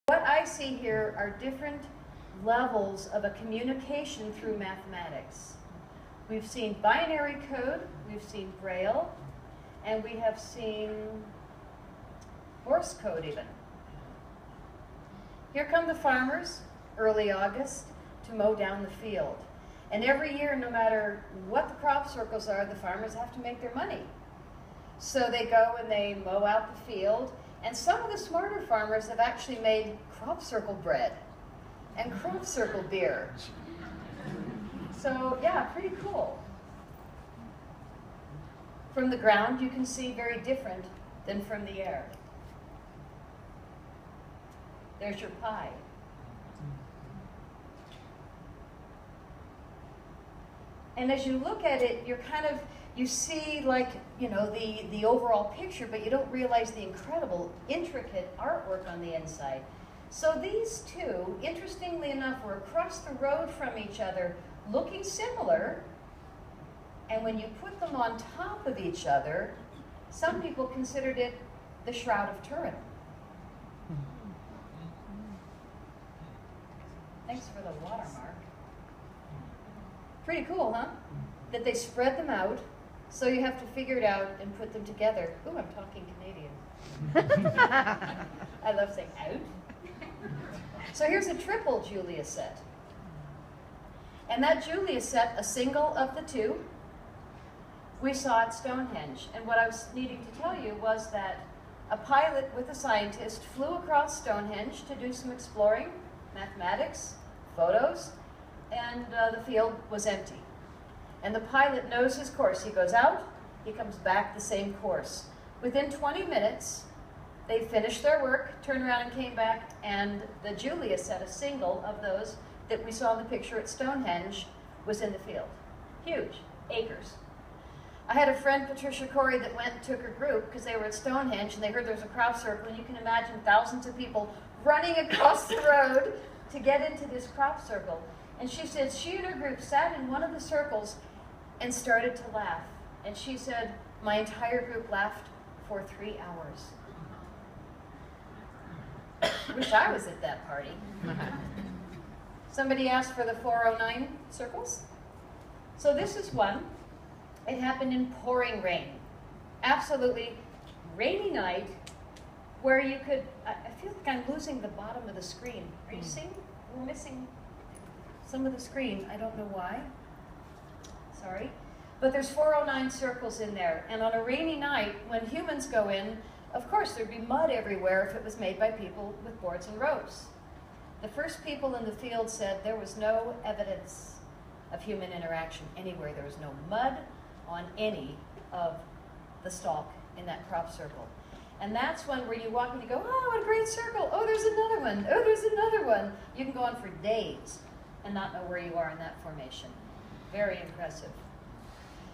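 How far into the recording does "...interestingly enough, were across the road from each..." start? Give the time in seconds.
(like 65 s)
61 s.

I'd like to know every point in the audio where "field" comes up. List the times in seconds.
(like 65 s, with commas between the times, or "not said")
18 s, 26 s, 109 s, 125 s, 181 s.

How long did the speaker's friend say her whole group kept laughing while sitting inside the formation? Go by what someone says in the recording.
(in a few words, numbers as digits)
3 hours.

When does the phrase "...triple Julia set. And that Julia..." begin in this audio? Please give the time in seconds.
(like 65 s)
91 s.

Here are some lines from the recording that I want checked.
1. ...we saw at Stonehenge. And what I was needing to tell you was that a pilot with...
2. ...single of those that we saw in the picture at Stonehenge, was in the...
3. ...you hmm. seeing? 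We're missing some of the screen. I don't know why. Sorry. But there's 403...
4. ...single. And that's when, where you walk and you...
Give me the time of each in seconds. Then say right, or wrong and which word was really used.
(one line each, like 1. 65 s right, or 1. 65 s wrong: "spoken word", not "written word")
1. 98 s right
2. 121 s right
3. 165 s wrong: "409", not "403"
4. 190 s wrong: "circle", not "single".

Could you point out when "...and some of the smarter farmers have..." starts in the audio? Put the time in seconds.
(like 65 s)
27 s.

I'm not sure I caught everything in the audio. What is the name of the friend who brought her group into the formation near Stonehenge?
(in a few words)
Patricia Corey.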